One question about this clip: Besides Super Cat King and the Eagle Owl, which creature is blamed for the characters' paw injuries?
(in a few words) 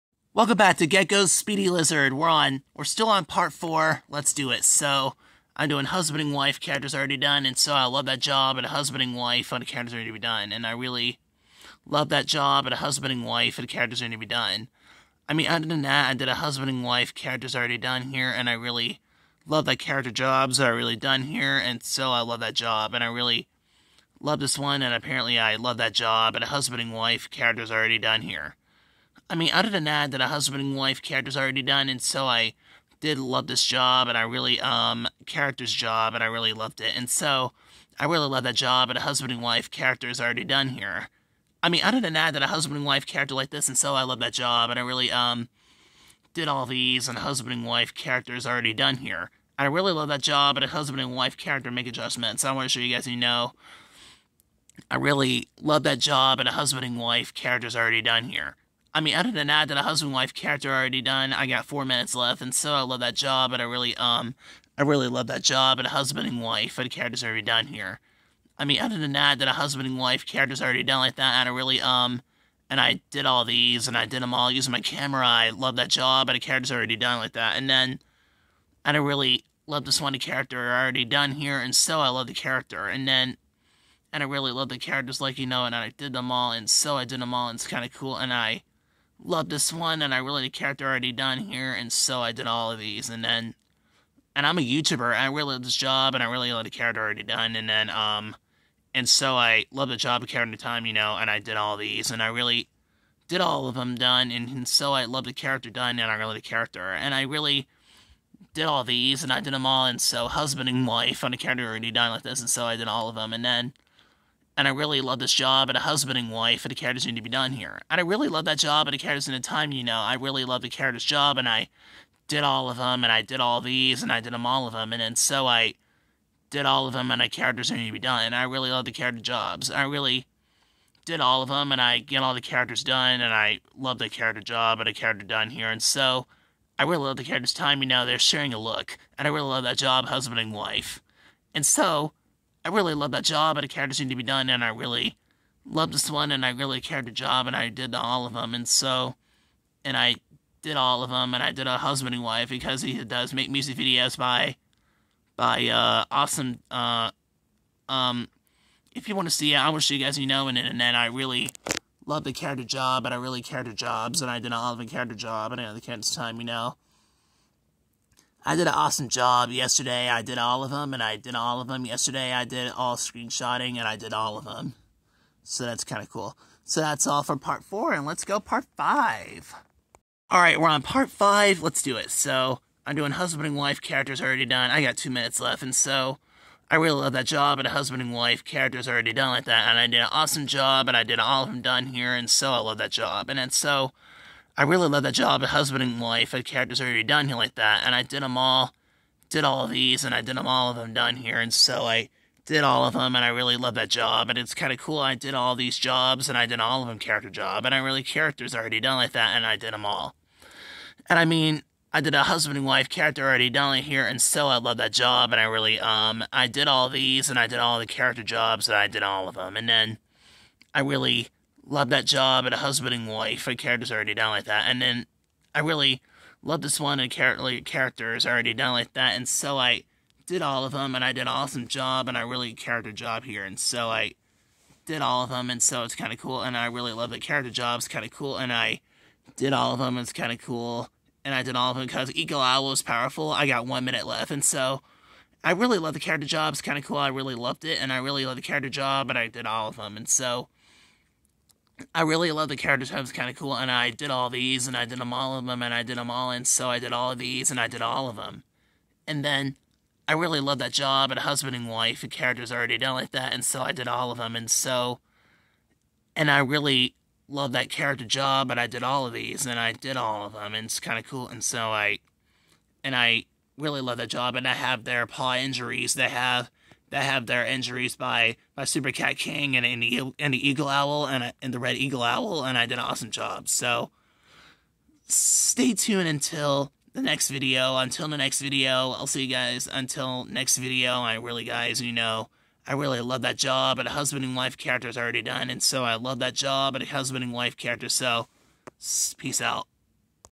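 Red Eagle Owl.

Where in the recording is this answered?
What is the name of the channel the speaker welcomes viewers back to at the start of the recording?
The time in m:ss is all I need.
0:00.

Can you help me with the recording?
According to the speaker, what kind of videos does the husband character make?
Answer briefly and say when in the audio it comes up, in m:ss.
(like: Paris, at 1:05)
Music videos, at 2:33.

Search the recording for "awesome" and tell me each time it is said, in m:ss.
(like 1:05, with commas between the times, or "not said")
2:36, 2:48, 3:10, 3:51, 4:42.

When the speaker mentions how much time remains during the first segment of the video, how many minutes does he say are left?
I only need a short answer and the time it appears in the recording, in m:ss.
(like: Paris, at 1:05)
4, at 1:01.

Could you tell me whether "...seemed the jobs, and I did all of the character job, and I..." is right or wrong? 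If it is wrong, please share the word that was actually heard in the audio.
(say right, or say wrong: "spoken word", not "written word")
wrong: "cared", not "seemed".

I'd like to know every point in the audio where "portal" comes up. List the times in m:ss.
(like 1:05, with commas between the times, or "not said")
not said.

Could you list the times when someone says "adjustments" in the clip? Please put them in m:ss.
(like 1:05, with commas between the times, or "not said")
0:51.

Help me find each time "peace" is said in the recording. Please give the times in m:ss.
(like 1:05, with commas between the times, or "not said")
4:59.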